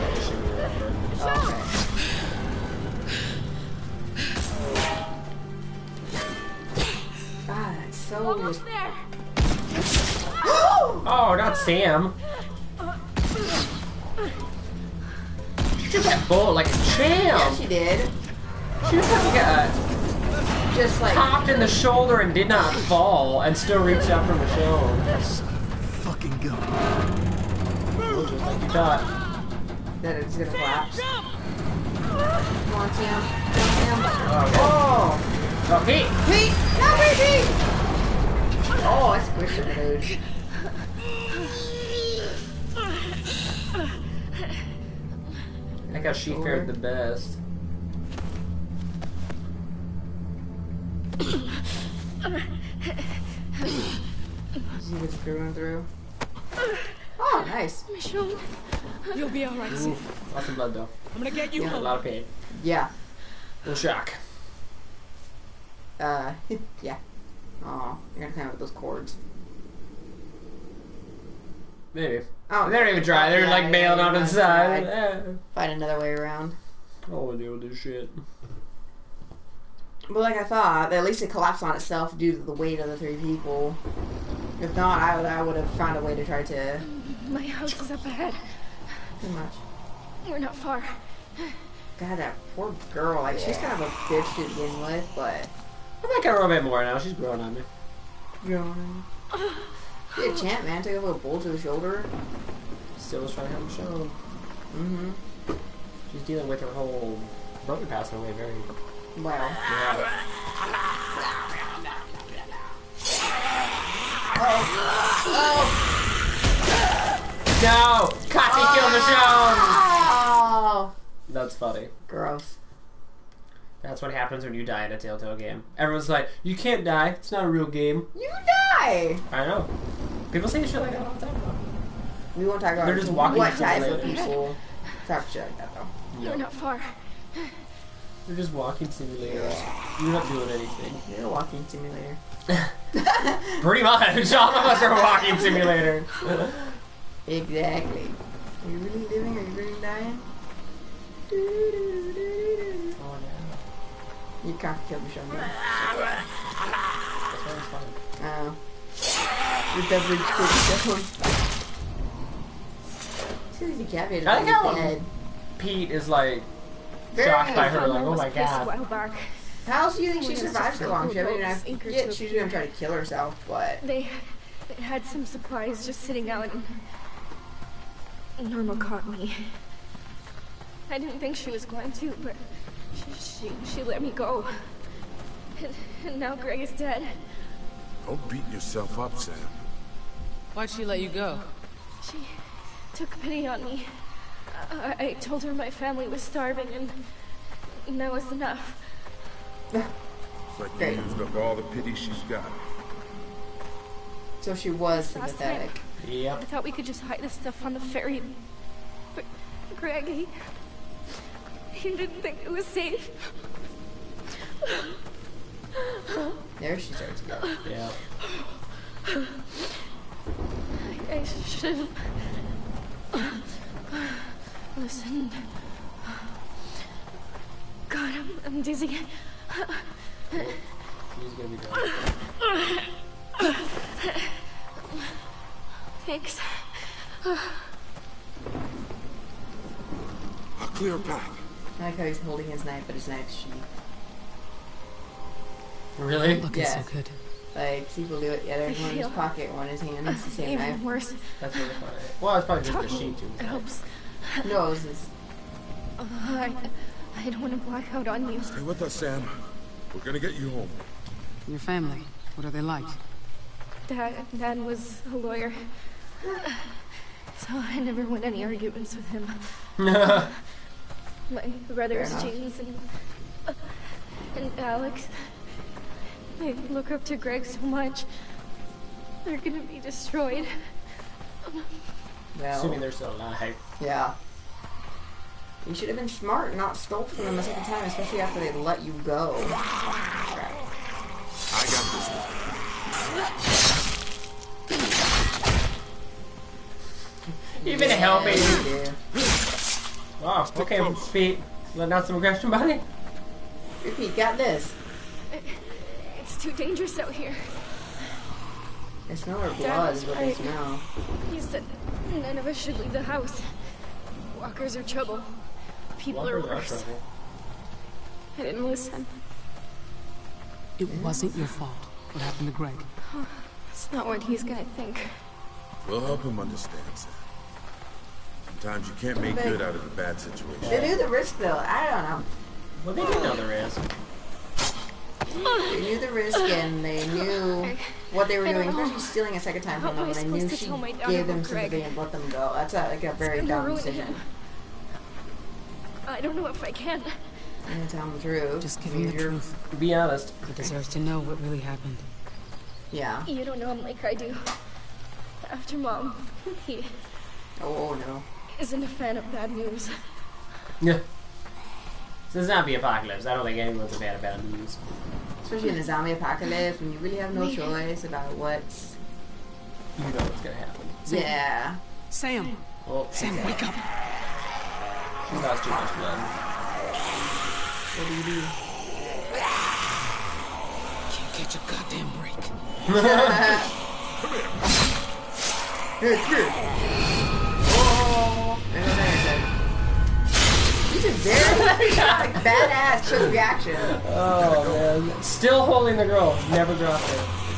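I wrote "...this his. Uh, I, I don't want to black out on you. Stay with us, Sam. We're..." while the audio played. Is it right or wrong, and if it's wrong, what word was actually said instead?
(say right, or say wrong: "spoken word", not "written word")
right.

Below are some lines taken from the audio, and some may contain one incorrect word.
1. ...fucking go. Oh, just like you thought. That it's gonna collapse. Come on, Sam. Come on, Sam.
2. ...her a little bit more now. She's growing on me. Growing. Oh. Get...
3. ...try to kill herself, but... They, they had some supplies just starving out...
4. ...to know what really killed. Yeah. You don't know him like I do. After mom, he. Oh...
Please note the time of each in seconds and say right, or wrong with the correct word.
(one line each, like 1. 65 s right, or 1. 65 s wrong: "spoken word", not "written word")
1. 25 s right
2. 96 s right
3. 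172 s wrong: "sitting", not "starving"
4. 350 s wrong: "happened", not "killed".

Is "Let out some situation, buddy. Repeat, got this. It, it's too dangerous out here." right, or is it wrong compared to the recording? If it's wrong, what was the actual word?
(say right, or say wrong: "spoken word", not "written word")
wrong: "aggression", not "situation".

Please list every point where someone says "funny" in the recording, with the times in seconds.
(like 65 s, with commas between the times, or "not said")
121 s, 251 s.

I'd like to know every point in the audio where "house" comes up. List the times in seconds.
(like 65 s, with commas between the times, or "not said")
87 s, 313 s.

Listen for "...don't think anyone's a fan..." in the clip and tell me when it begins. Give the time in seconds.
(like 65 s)
363 s.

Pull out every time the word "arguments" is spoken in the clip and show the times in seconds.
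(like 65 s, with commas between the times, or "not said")
268 s.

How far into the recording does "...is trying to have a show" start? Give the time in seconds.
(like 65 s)
103 s.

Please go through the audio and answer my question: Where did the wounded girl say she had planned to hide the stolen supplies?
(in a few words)
On the ferry.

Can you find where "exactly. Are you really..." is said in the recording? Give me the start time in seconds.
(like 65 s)
147 s.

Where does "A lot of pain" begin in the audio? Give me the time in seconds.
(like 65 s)
61 s.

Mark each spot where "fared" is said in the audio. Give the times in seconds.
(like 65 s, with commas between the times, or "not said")
46 s.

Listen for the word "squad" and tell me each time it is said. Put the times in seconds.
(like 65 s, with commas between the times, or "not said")
not said.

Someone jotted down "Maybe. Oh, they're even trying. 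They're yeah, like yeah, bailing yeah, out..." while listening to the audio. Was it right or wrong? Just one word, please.
right.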